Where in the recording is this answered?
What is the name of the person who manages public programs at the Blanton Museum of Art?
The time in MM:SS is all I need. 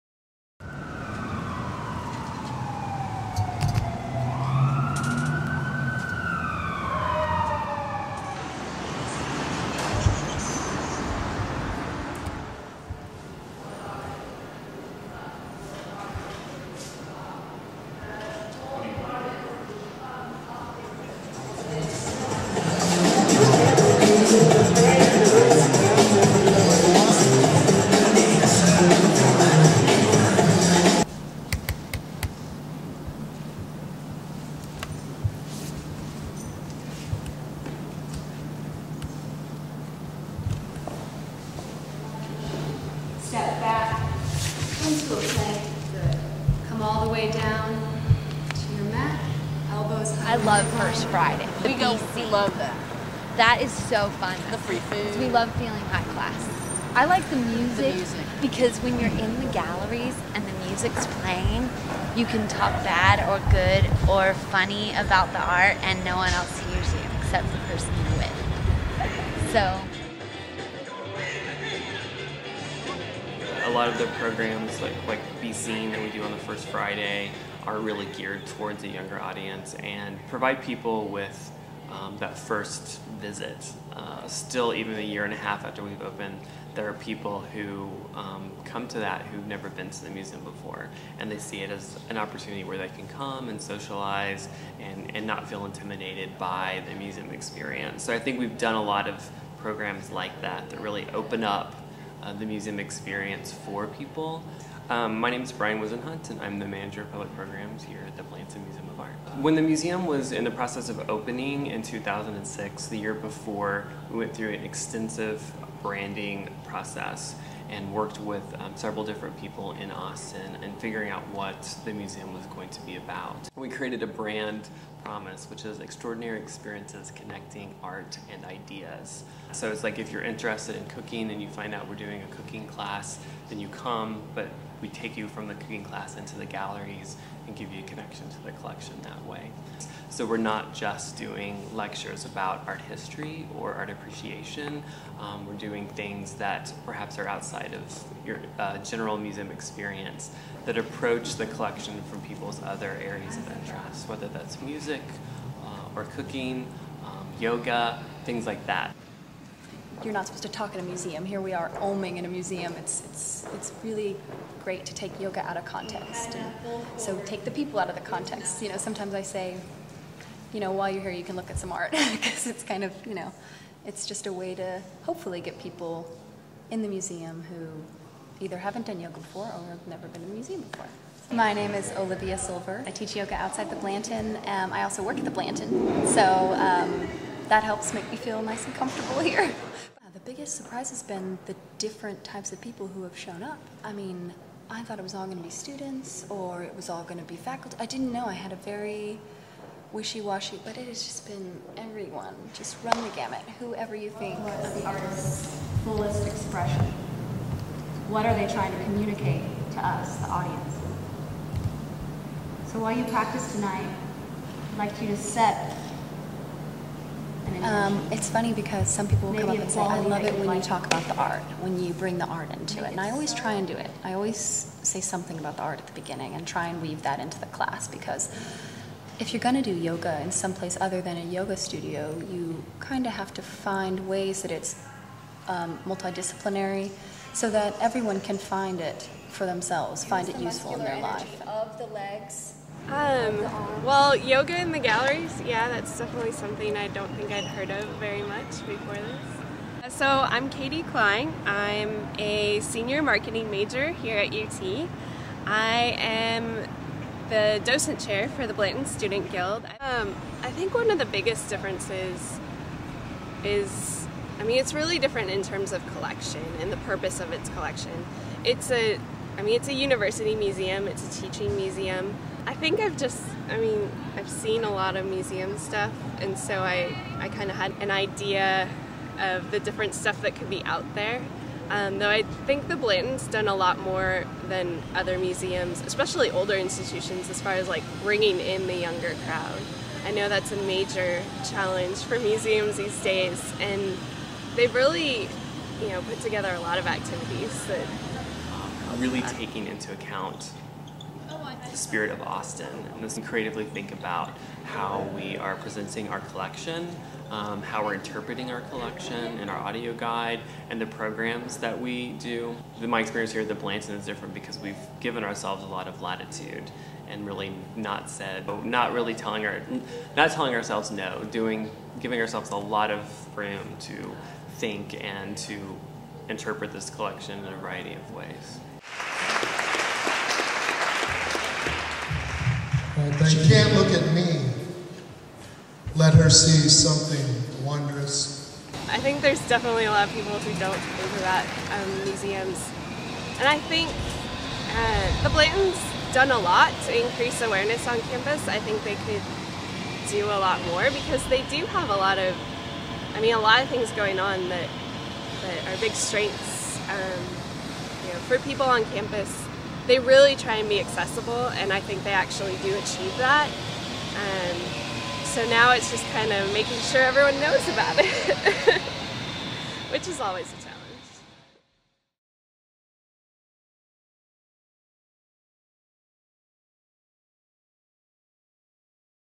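01:45.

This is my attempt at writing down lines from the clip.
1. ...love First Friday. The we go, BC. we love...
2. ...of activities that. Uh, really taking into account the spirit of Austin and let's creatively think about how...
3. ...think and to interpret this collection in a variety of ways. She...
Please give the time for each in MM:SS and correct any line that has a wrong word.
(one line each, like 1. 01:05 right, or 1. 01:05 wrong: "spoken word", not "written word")
1. 00:50 right
2. 04:56 right
3. 05:24 right.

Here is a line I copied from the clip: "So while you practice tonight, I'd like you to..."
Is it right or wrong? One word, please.
right.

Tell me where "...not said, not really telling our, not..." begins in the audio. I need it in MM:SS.
05:17.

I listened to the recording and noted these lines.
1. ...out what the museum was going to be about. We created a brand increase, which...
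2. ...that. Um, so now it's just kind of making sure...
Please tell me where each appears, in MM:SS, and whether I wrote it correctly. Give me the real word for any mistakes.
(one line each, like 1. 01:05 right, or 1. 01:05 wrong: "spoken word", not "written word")
1. 02:01 wrong: "promise", not "increase"
2. 06:03 right.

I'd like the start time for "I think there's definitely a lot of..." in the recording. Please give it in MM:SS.
05:38.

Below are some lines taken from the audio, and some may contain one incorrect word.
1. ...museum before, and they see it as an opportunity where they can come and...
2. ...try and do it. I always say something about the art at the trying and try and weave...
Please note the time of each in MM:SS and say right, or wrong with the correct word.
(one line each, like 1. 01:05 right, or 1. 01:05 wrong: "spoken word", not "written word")
1. 01:30 right
2. 03:43 wrong: "beginning", not "trying".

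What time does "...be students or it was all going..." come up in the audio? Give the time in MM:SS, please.
03:15.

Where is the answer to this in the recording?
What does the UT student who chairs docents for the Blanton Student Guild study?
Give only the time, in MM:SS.
04:13.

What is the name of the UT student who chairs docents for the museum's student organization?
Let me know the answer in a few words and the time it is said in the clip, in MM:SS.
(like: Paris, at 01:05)
Katie Klein, at 04:10.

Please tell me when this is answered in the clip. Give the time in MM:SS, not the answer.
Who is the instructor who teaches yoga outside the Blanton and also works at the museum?
03:01.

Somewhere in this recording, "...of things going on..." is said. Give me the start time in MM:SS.
05:53.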